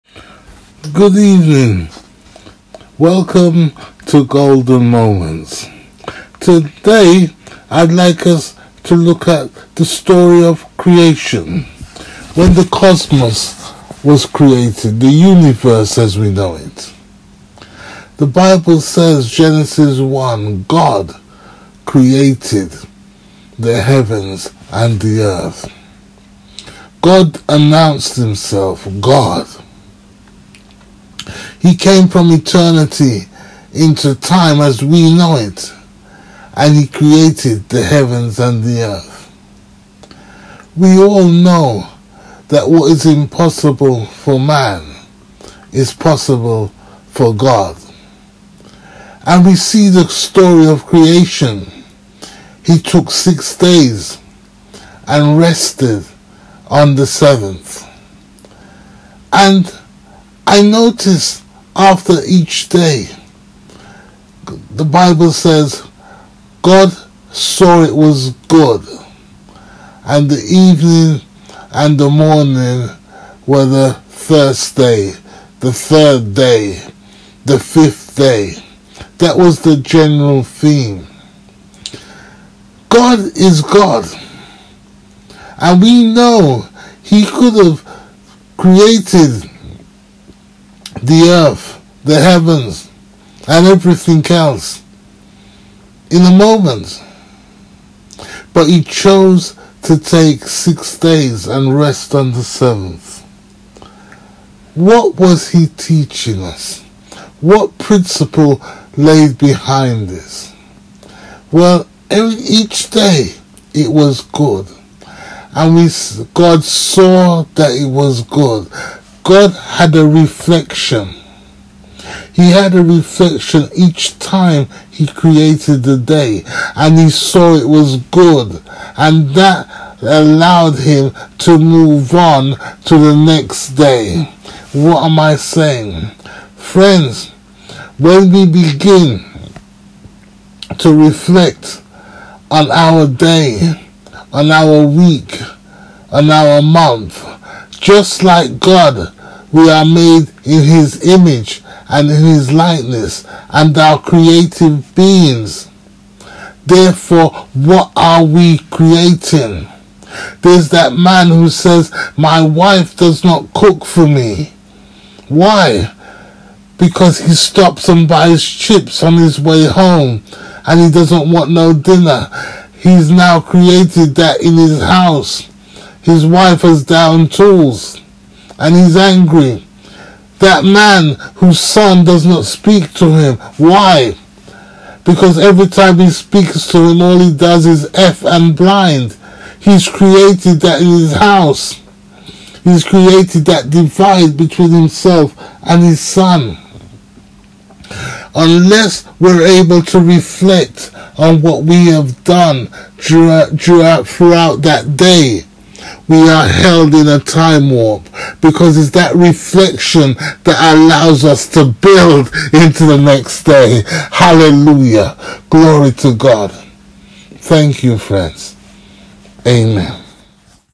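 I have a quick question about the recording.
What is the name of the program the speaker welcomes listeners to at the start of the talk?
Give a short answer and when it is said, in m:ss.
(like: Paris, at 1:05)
Golden Moments, at 0:04.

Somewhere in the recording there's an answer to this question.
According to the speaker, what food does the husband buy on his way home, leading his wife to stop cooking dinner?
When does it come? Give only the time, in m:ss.
2:48.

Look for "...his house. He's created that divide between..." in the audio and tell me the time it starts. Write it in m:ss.
3:10.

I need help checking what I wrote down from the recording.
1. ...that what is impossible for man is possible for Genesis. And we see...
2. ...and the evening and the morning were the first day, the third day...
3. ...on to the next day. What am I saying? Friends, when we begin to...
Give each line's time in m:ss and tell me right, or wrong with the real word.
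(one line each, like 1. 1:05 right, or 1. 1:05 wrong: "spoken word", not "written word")
1. 0:42 wrong: "God", not "Genesis"
2. 1:10 right
3. 2:12 right.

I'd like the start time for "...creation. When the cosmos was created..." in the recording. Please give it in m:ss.
0:10.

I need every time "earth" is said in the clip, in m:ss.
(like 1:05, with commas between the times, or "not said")
0:25, 0:38, 1:31.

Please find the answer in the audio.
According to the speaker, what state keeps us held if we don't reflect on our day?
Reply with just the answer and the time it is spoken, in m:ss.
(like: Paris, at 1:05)
a time warp, at 3:27.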